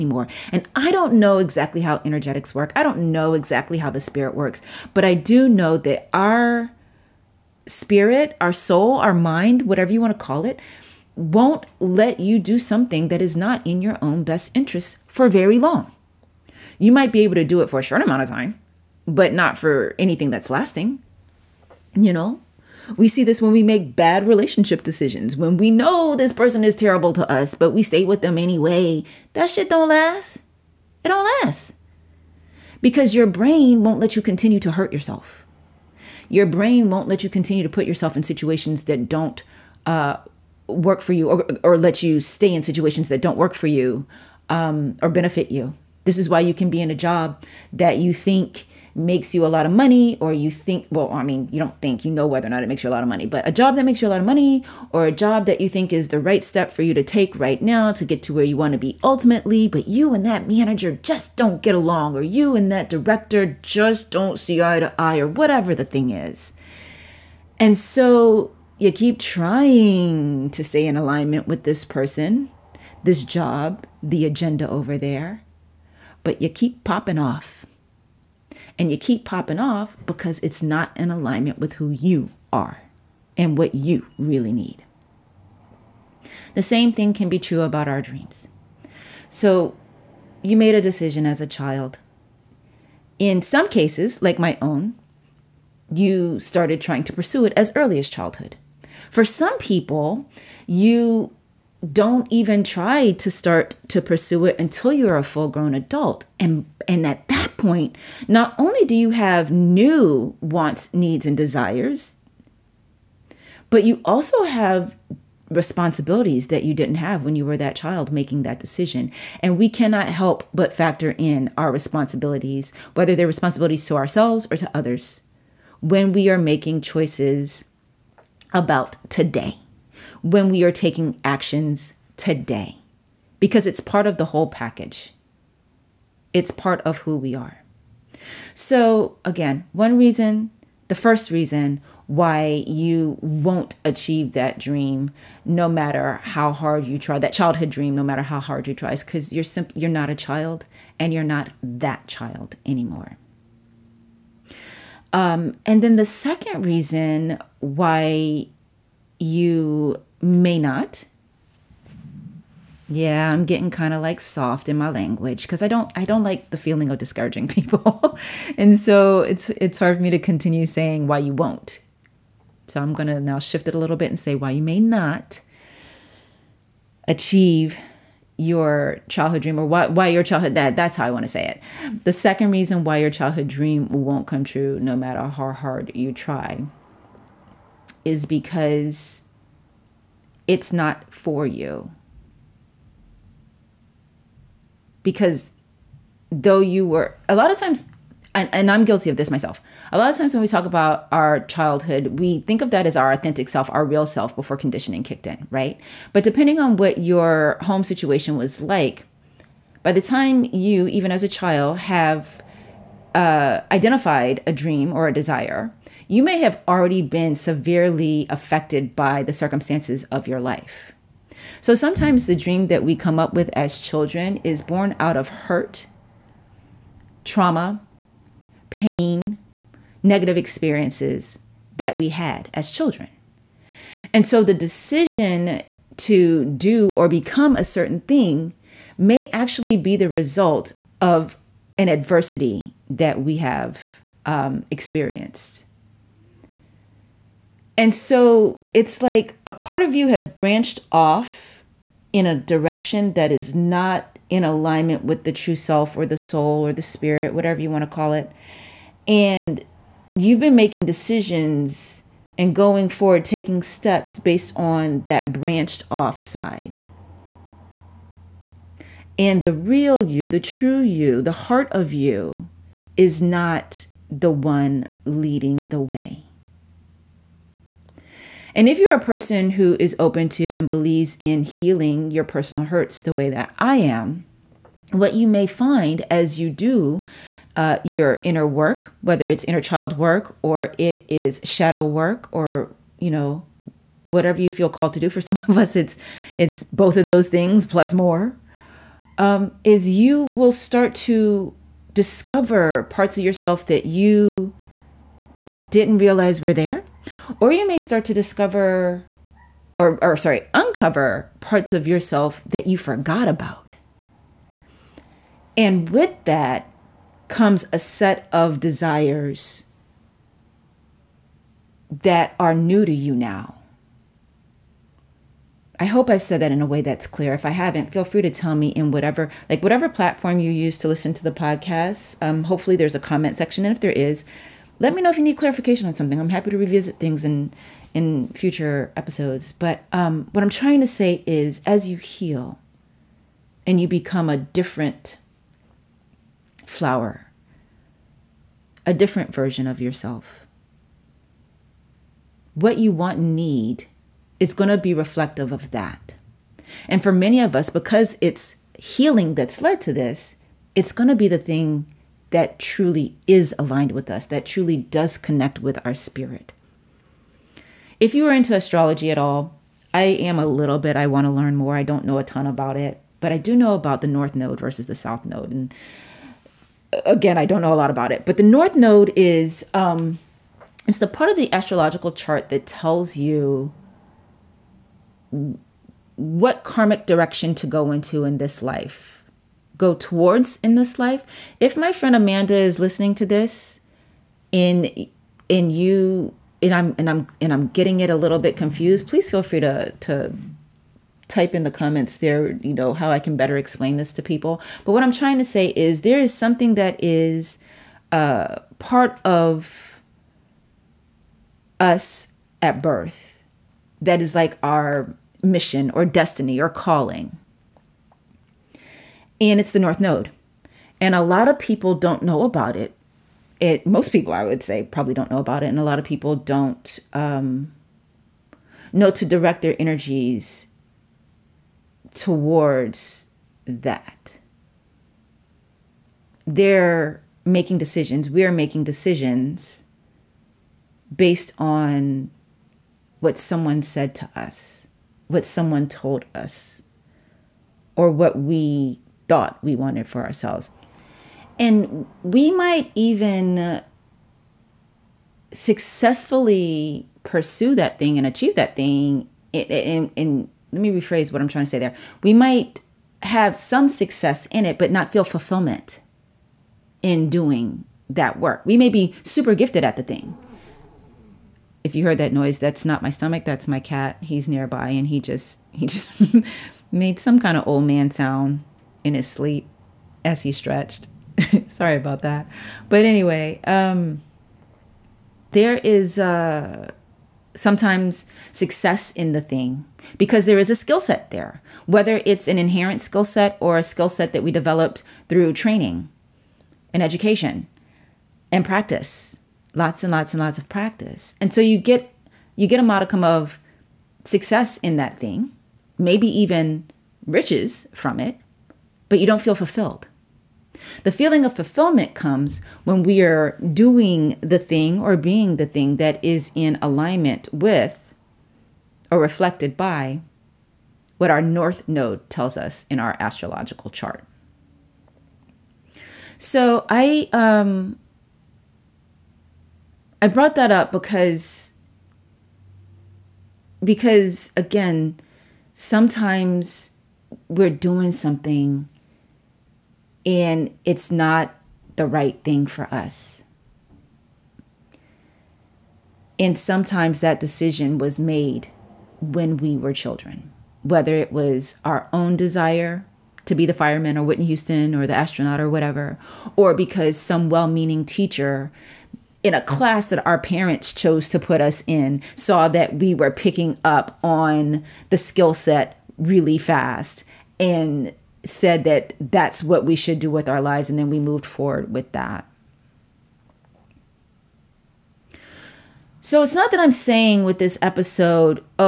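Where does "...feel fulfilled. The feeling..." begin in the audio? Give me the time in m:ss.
8:29.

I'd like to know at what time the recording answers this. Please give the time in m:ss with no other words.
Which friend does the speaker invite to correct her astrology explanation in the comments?
6:32.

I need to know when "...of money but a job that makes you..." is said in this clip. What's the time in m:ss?
0:53.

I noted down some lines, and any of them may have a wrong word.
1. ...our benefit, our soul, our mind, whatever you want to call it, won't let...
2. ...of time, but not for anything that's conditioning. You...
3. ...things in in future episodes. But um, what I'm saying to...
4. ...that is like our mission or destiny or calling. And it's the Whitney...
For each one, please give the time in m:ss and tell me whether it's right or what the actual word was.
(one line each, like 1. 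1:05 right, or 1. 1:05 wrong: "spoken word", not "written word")
1. 0:06 wrong: "spirit", not "benefit"
2. 0:18 wrong: "lasting", not "conditioning"
3. 5:36 wrong: "trying", not "saying"
4. 6:54 wrong: "North", not "Whitney".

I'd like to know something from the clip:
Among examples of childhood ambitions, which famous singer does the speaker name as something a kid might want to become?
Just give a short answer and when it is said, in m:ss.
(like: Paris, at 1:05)
Whitney Houston, at 9:14.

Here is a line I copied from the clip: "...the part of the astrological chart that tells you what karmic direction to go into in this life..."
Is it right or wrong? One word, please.
right.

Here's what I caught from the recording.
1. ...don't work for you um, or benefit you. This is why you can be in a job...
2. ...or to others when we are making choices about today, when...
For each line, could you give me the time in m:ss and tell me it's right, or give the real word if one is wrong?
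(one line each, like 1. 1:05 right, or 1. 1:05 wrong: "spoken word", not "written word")
1. 0:43 right
2. 2:04 right.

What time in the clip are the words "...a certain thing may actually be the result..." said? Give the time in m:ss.
3:57.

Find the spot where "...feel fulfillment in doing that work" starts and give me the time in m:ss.
7:45.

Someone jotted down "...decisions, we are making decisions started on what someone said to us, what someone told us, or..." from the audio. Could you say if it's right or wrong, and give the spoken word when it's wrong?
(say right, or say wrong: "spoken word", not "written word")
wrong: "based", not "started".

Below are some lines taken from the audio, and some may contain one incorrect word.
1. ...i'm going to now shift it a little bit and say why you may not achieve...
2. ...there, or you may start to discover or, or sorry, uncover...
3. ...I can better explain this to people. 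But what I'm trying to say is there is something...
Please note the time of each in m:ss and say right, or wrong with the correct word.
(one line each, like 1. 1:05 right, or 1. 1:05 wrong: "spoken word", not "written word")
1. 2:52 right
2. 5:06 right
3. 6:43 right.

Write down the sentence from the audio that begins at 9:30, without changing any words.
And then we moved forward with that.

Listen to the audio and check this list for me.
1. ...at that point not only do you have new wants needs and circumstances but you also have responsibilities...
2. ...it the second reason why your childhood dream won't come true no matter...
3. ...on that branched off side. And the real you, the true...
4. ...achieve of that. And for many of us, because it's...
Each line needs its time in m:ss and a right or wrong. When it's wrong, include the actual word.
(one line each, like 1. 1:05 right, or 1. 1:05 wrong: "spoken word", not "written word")
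1. 1:47 wrong: "desires", not "circumstances"
2. 3:01 right
3. 4:24 right
4. 5:54 wrong: "reflective", not "achieve".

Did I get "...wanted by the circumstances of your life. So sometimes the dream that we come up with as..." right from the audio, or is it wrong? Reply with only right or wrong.
wrong.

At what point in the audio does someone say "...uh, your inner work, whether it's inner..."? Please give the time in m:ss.
4:47.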